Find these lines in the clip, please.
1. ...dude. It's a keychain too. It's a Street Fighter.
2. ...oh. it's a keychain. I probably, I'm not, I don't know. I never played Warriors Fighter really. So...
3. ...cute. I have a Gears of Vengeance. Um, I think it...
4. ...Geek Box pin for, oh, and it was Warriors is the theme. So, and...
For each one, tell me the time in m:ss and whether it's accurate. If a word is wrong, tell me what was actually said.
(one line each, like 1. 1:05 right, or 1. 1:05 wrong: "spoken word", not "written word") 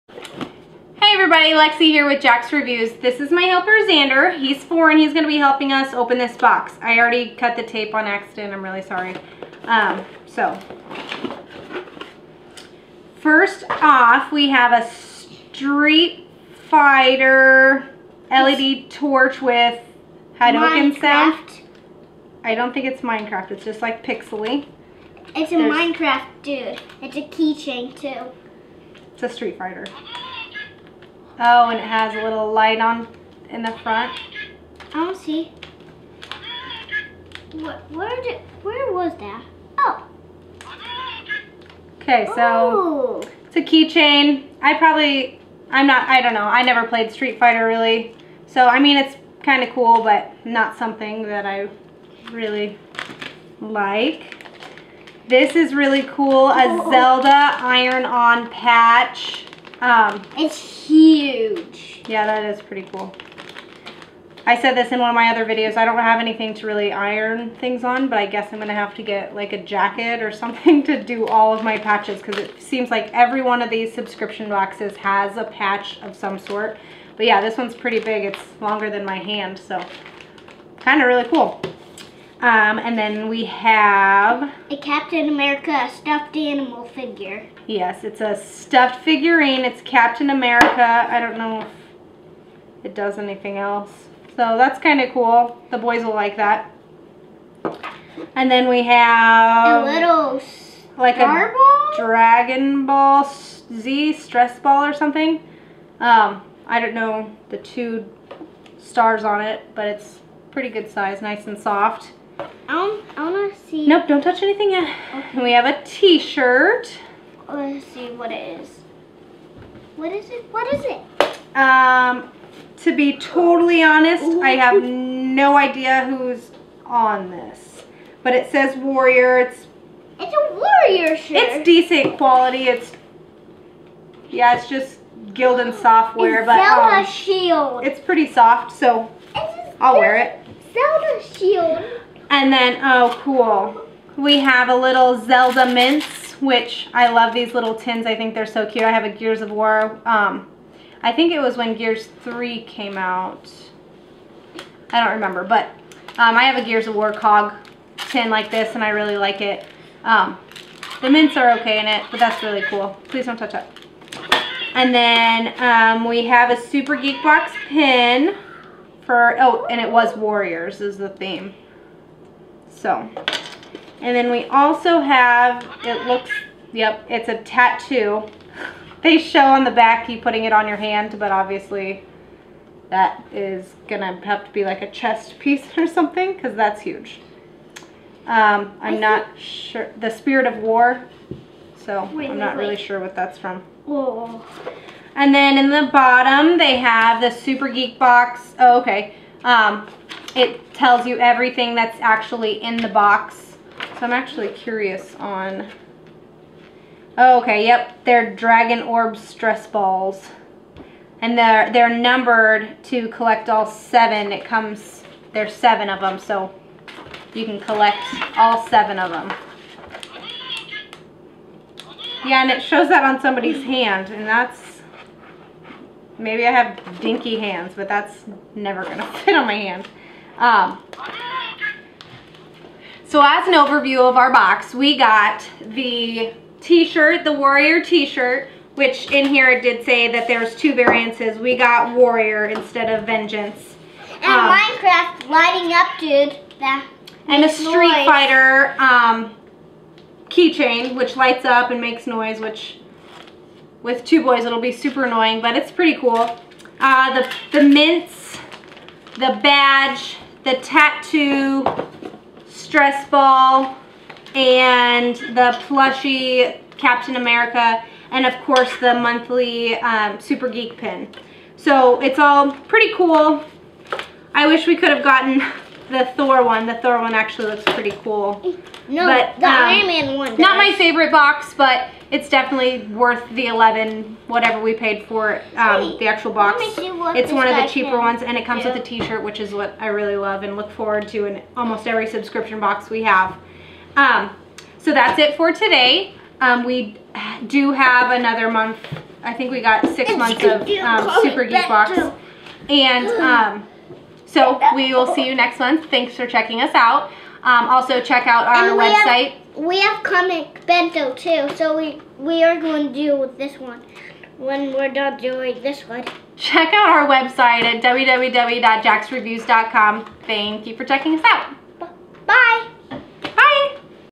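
1. 0:26 right
2. 0:42 wrong: "Street", not "Warriors"
3. 2:28 wrong: "War", not "Vengeance"
4. 2:46 right.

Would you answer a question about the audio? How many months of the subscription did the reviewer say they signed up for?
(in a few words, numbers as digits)
6.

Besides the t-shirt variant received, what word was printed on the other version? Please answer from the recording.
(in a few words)
Vengeance.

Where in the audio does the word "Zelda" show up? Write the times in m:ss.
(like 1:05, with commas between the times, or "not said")
0:56, 2:16, 2:20, 2:25.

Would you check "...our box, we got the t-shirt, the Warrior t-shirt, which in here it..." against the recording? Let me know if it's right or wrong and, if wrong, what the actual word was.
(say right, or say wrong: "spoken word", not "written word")
right.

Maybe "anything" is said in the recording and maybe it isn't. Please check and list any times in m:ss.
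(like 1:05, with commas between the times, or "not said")
1:06, 1:33, 1:54.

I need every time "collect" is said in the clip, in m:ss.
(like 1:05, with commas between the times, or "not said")
3:33, 3:37.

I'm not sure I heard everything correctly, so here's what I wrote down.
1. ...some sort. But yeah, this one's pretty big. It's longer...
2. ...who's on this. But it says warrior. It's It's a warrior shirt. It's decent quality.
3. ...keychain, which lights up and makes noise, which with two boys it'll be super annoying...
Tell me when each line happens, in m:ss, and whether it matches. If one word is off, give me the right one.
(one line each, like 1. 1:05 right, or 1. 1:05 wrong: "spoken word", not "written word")
1. 1:16 right
2. 2:06 right
3. 4:10 right.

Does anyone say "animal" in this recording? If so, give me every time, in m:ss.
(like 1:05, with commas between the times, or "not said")
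1:26.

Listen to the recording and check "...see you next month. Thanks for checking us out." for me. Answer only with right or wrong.
right.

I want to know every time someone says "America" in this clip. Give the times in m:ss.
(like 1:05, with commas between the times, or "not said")
1:25, 1:30, 4:27.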